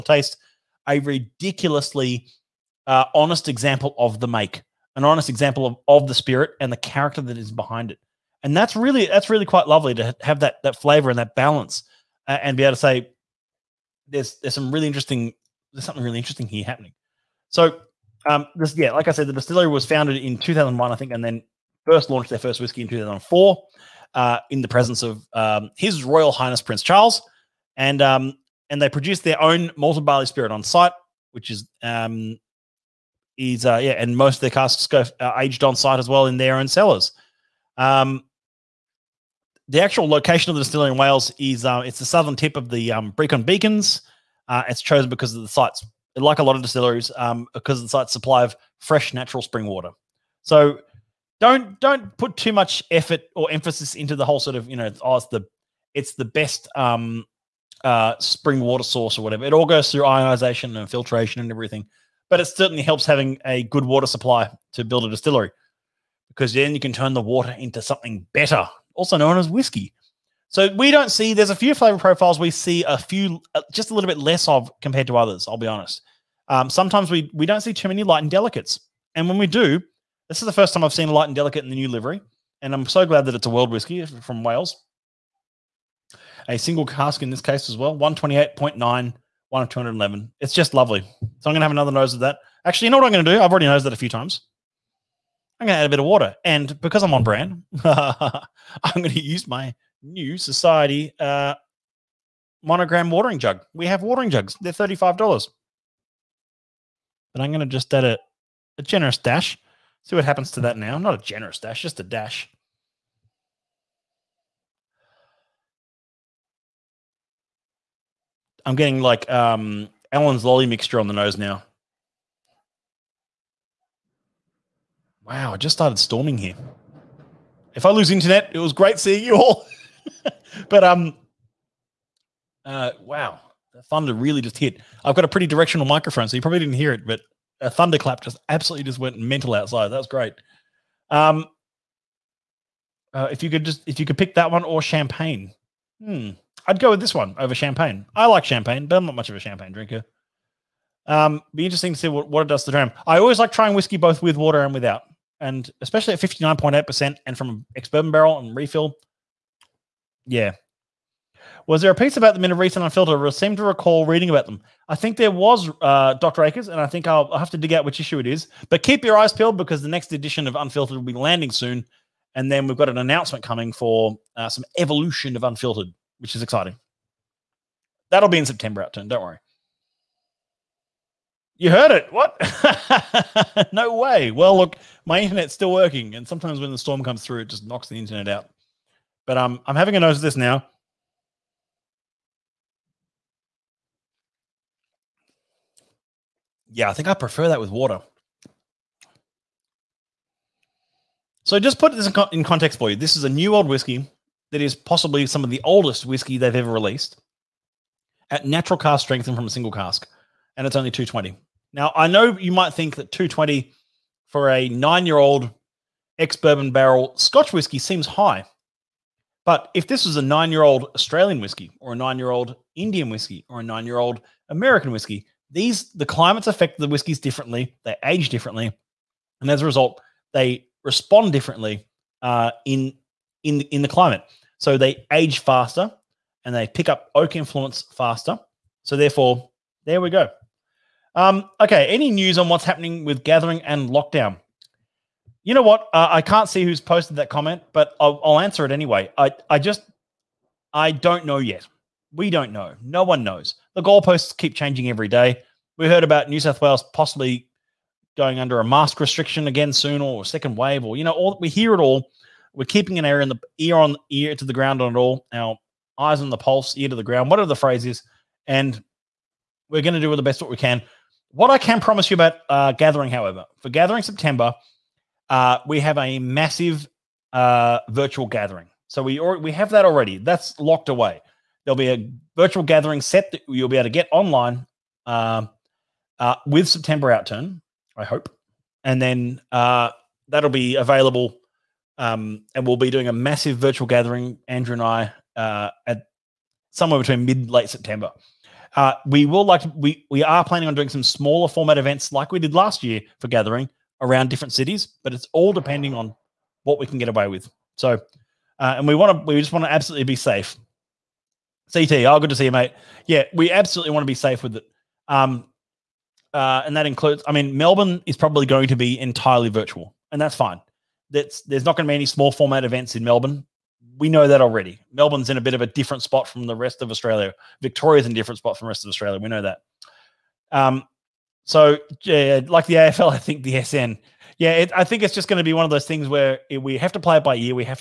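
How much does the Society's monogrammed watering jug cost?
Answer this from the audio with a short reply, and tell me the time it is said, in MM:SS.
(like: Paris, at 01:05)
$35, at 01:44.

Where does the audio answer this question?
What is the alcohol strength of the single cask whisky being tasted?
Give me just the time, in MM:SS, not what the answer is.
02:36.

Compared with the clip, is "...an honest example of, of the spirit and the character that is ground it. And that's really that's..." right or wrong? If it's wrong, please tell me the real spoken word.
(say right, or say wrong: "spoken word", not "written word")
wrong: "behind", not "ground".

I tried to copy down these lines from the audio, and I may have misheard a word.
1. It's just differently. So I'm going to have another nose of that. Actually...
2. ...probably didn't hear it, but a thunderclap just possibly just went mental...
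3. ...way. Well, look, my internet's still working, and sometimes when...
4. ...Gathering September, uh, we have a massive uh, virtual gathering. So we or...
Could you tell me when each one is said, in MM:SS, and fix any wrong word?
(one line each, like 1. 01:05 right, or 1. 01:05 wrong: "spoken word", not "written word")
1. 01:30 wrong: "lovely", not "differently"
2. 02:16 wrong: "absolutely", not "possibly"
3. 03:03 right
4. 04:33 right.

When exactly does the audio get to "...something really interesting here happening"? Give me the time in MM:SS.
00:15.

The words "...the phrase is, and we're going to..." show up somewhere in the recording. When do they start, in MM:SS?
04:27.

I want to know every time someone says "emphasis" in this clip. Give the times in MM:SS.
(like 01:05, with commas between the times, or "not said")
00:53.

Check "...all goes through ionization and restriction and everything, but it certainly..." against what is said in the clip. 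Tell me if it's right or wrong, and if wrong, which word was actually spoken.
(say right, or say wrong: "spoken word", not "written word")
wrong: "filtration", not "restriction".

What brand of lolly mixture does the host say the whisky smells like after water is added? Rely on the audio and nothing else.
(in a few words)
Allen's.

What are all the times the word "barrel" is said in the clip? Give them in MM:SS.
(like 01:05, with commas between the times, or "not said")
02:38, 03:36.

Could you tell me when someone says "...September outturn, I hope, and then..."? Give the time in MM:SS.
04:46.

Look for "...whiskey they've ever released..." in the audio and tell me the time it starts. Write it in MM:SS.
03:26.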